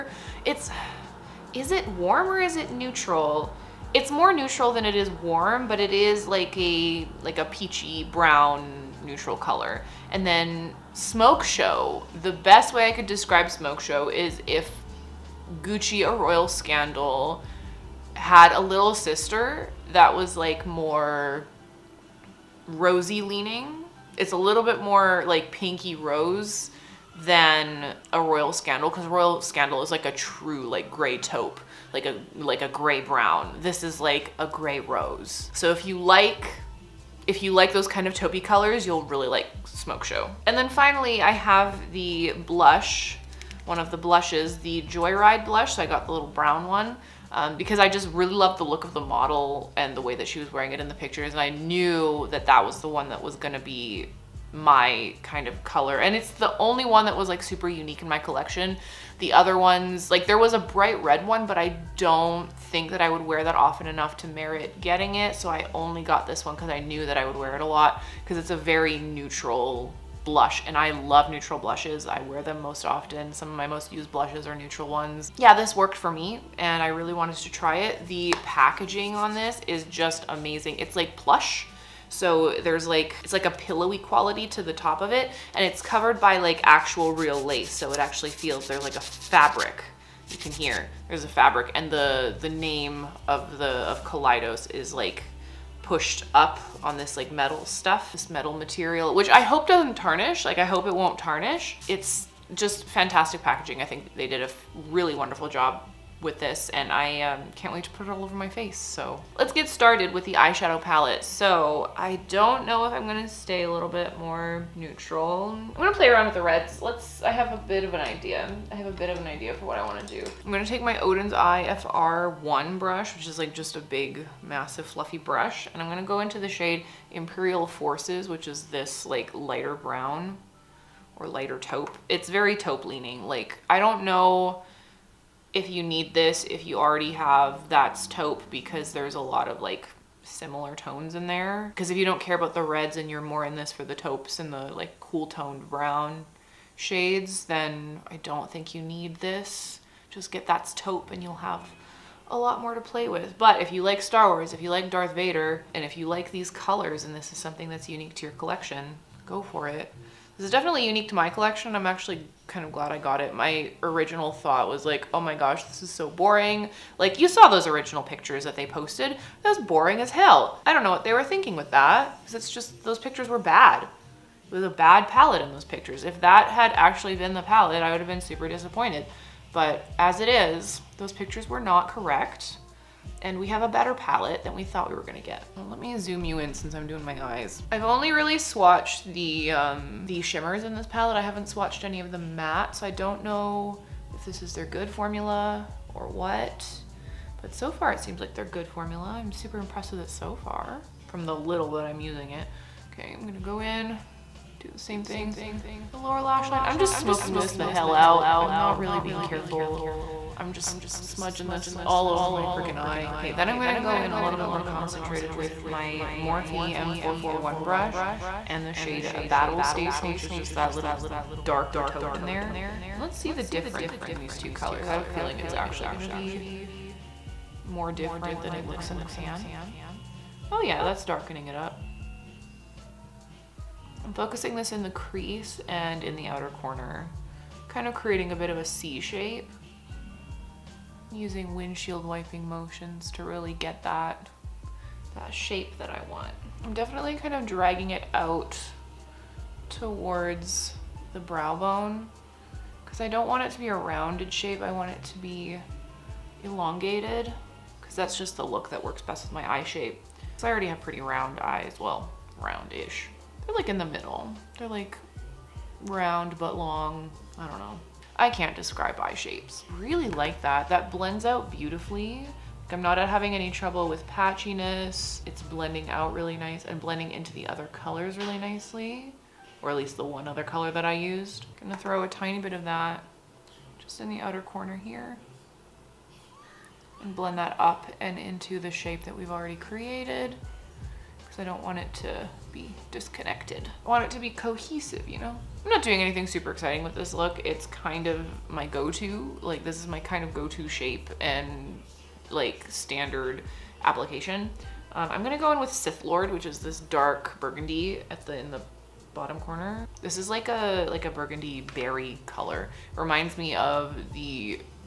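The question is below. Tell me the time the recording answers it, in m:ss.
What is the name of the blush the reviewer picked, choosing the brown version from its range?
0:44.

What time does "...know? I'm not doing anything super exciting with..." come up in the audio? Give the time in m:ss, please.
4:55.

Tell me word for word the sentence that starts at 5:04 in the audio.
Um, I'm gonna go in with Sith Lord, which is this dark burgundy at the in the bottom corner.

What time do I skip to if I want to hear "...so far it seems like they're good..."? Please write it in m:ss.
3:17.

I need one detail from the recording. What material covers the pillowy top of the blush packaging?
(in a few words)
Lace.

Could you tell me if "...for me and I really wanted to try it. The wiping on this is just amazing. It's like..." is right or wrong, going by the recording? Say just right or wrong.
wrong.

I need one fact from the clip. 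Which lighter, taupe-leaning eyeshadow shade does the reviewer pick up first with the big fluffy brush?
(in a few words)
Imperial Forces.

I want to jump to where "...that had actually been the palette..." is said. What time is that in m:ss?
2:56.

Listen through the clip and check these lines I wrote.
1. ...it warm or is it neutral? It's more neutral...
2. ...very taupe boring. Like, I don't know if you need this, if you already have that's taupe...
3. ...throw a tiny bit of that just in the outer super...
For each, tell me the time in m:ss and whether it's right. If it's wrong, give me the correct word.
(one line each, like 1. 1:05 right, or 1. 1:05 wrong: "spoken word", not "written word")
1. 0:01 right
2. 2:12 wrong: "leaning", not "boring"
3. 4:41 wrong: "corner", not "super".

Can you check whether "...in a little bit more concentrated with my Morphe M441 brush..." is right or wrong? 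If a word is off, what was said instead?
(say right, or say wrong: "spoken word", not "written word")
right.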